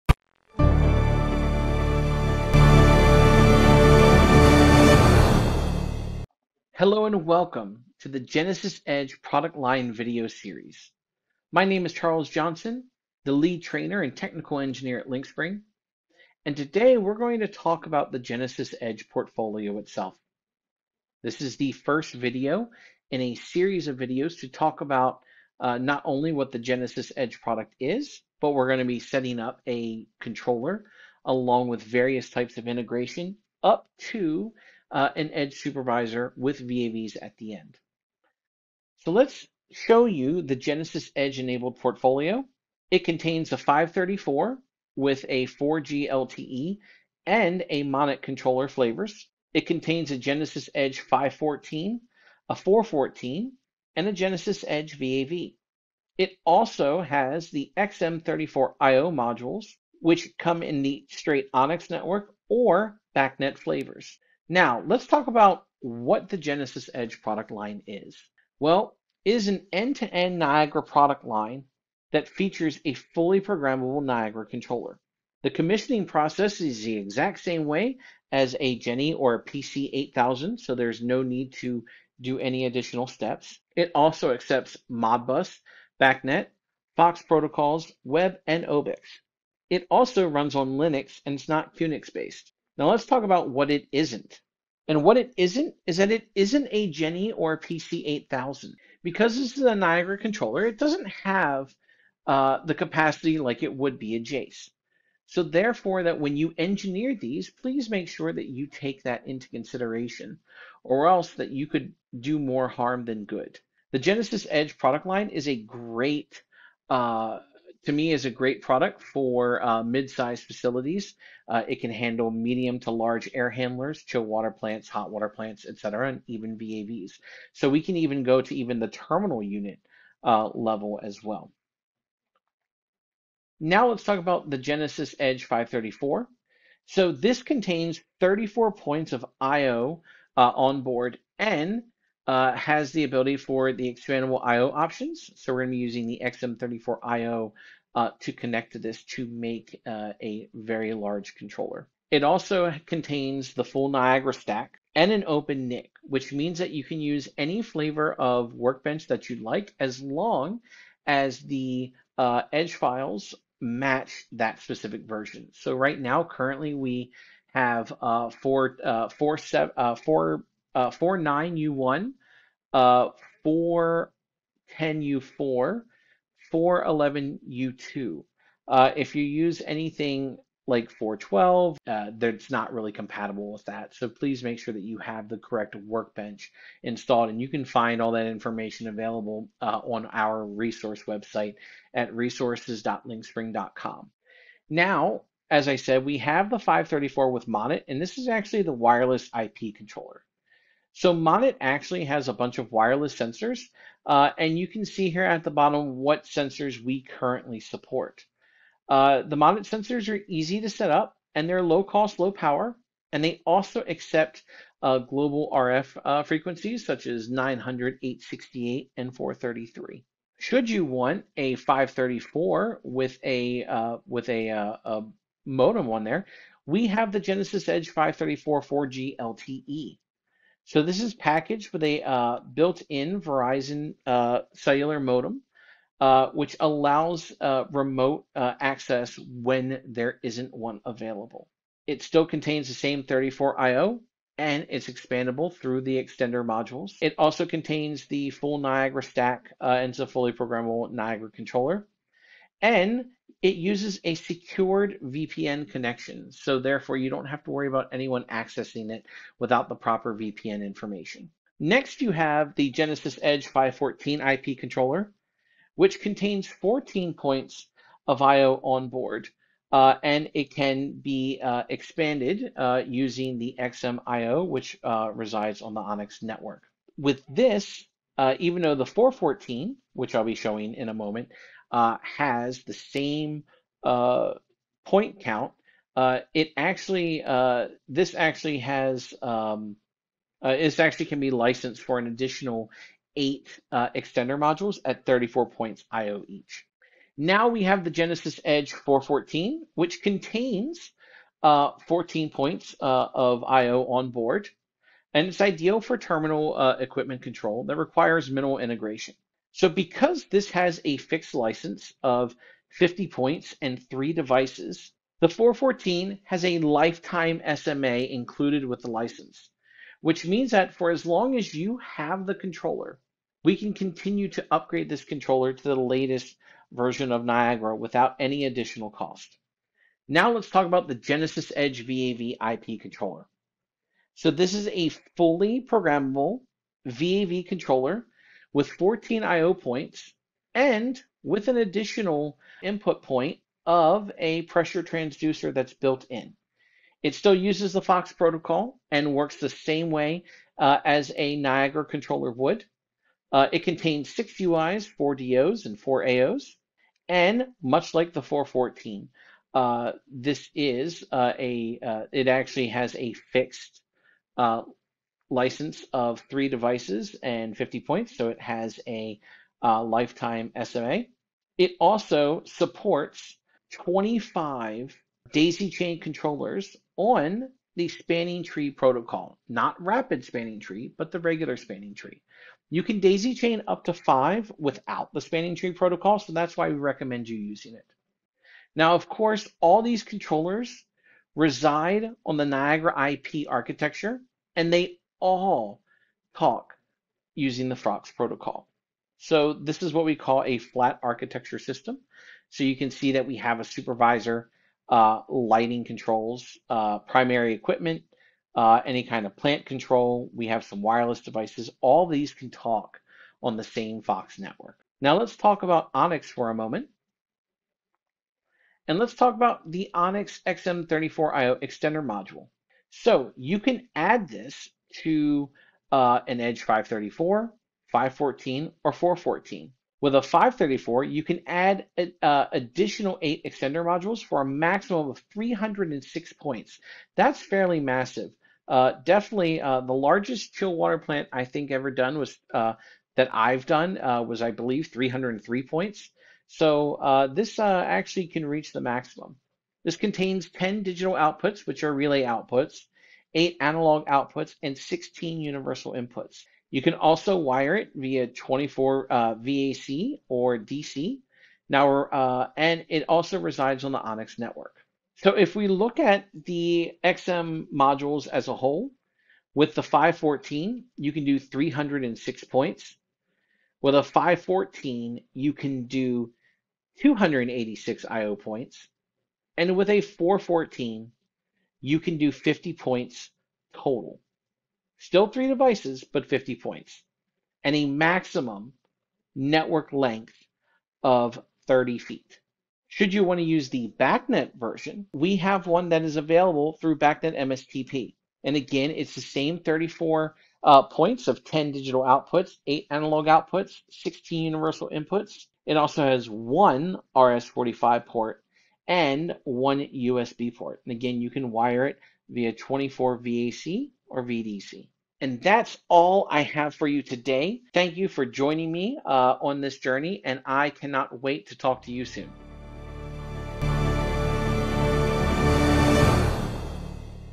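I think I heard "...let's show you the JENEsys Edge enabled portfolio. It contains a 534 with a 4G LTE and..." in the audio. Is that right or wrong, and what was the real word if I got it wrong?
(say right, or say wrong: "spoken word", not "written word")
right.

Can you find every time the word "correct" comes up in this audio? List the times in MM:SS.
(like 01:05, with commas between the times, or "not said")
03:05.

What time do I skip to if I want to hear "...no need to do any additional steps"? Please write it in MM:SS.
01:21.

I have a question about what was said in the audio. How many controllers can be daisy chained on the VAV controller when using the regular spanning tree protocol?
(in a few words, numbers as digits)
25.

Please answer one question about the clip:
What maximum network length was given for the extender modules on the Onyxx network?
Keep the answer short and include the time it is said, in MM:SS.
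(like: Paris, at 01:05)
30 feet, at 08:11.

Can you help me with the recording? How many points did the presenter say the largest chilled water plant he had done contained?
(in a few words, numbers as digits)
303.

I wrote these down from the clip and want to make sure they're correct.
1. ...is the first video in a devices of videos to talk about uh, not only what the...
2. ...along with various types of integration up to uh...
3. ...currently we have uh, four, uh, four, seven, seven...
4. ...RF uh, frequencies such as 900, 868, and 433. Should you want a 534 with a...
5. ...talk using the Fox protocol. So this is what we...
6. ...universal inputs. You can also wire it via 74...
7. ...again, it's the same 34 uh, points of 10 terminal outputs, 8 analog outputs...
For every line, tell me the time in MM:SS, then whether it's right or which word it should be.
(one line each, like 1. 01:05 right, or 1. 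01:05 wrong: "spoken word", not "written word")
1. 00:21 wrong: "series", not "devices"
2. 00:31 right
3. 02:46 wrong: "four", not "seven"
4. 03:35 right
5. 06:36 right
6. 07:35 wrong: "24", not "74"
7. 08:18 wrong: "digital", not "terminal".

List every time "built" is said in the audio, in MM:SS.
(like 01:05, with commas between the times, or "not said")
03:52, 05:45.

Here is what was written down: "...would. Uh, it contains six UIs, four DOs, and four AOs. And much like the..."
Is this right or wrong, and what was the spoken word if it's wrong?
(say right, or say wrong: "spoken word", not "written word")
right.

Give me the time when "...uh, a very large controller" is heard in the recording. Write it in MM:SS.
02:29.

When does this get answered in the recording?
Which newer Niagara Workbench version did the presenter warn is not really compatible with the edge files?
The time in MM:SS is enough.
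03:00.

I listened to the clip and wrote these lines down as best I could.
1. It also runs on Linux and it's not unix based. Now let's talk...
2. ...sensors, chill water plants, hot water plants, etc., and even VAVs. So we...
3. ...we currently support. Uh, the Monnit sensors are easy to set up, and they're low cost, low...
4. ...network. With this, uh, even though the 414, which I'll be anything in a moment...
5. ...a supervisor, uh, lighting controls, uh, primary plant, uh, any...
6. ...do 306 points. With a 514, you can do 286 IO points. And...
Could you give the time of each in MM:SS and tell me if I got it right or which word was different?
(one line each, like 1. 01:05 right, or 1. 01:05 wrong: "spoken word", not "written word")
1. 01:29 right
2. 02:03 wrong: "handlers", not "sensors"
3. 03:26 right
4. 04:36 wrong: "showing", not "anything"
5. 06:43 wrong: "equipment", not "plant"
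6. 07:51 right.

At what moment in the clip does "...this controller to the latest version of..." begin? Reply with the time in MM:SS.
05:24.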